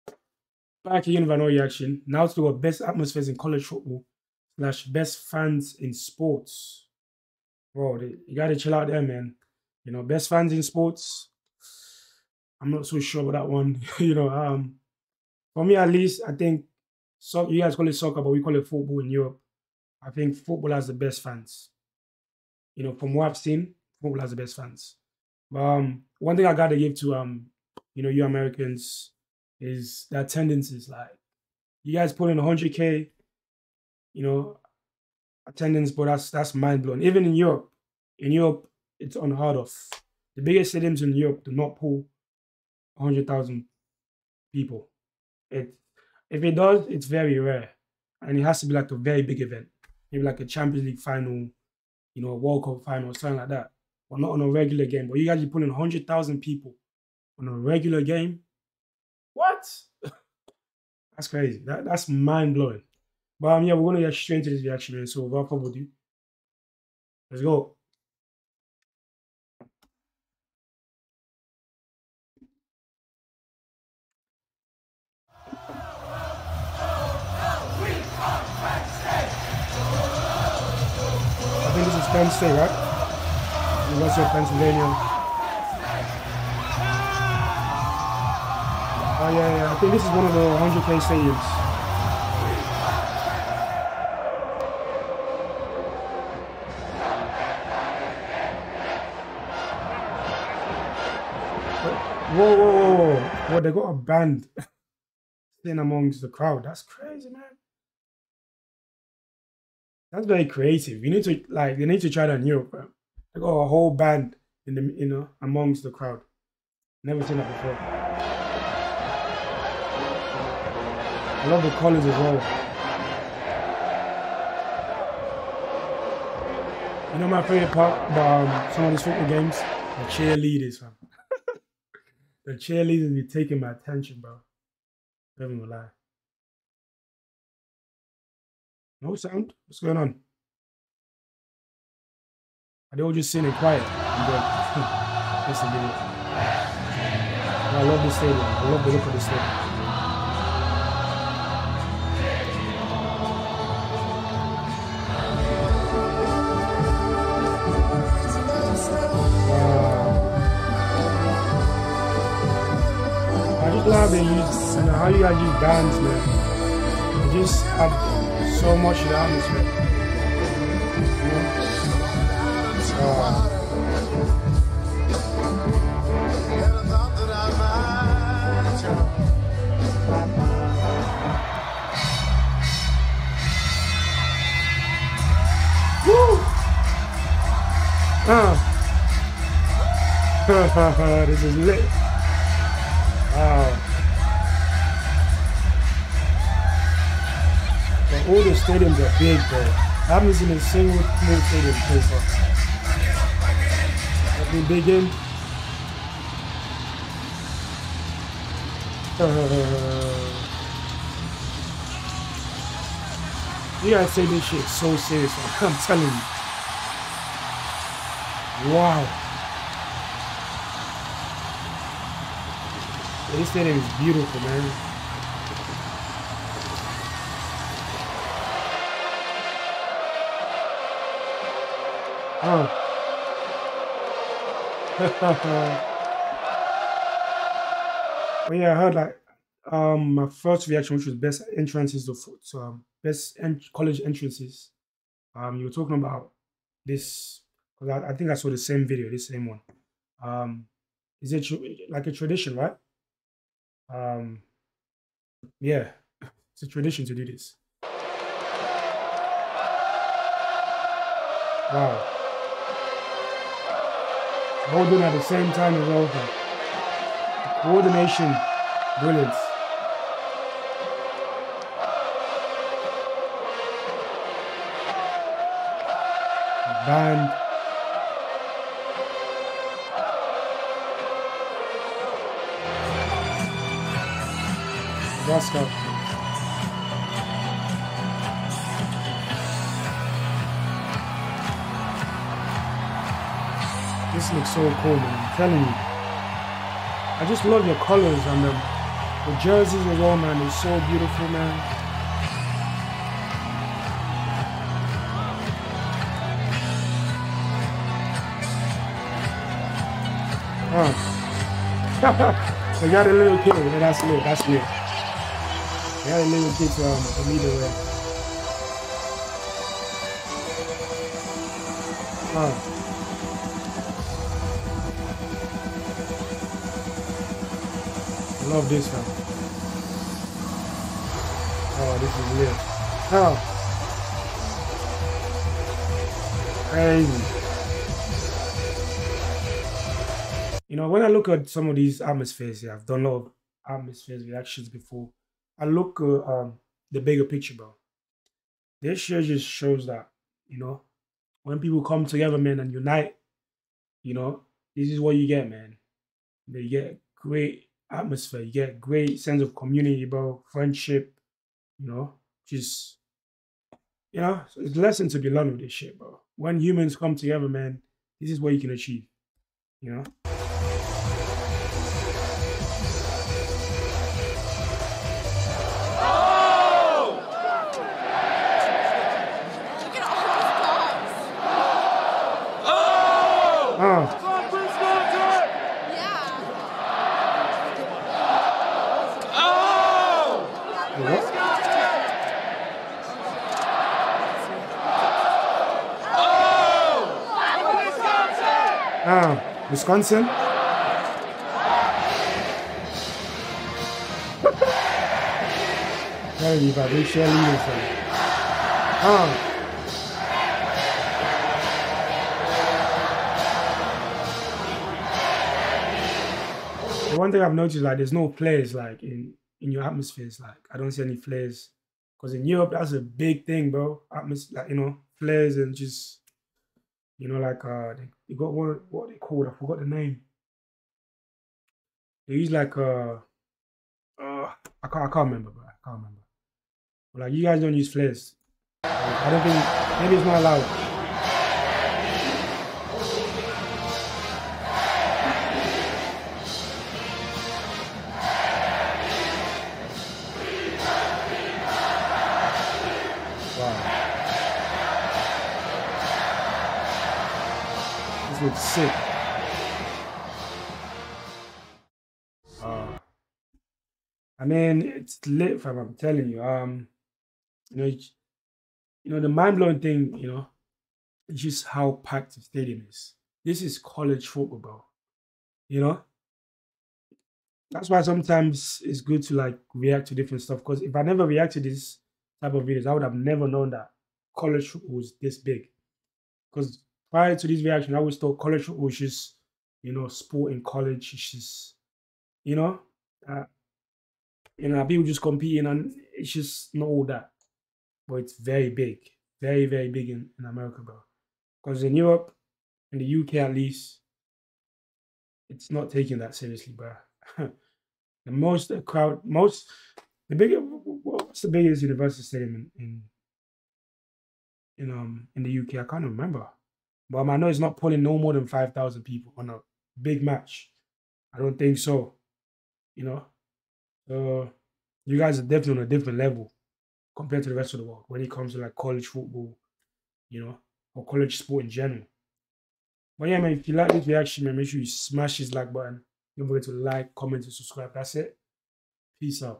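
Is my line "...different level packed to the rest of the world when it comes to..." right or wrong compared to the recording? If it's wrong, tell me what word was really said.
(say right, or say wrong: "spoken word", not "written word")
wrong: "compared", not "packed".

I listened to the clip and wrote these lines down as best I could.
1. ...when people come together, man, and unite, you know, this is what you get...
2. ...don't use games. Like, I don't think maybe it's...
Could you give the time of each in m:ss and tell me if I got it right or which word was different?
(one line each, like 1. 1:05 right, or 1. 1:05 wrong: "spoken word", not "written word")
1. 5:51 right
2. 7:17 wrong: "flares", not "games".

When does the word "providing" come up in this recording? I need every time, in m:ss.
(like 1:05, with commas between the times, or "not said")
not said.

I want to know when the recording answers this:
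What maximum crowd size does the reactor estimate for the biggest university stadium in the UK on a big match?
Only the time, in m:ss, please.
8:38.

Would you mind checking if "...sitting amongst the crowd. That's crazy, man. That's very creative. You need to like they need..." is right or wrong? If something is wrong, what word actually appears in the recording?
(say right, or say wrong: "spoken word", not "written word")
right.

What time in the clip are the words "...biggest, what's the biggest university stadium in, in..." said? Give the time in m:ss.
8:30.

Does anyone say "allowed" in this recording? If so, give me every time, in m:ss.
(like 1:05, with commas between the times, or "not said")
7:20.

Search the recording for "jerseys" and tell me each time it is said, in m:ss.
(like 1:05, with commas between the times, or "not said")
4:59.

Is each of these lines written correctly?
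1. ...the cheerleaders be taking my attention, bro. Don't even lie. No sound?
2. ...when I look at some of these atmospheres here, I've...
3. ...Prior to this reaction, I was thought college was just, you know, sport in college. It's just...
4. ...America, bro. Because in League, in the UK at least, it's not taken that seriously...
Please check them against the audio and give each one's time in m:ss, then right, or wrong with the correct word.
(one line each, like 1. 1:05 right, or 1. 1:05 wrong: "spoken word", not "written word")
1. 2:12 right
2. 5:40 right
3. 8:07 right
4. 8:20 wrong: "Europe", not "League".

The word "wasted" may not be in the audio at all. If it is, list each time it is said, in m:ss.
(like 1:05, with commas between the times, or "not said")
not said.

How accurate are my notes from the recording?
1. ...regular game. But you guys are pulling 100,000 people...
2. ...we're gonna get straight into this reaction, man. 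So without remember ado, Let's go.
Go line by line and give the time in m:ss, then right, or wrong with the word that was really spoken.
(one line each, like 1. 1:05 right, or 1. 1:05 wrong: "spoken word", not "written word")
1. 0:54 right
2. 1:03 wrong: "further", not "remember".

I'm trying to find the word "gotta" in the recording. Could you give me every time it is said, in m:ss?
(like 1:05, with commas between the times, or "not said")
0:08, 0:26.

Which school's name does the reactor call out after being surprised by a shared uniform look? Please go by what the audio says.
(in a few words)
Wisconsin.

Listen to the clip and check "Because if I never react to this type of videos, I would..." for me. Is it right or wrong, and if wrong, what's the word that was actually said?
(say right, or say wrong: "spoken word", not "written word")
right.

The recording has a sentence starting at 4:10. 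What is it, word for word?
Um, is it tr- like a tradition, right?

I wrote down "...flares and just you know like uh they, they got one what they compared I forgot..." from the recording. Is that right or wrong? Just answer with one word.
wrong.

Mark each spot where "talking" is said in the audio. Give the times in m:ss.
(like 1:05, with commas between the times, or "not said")
4:05.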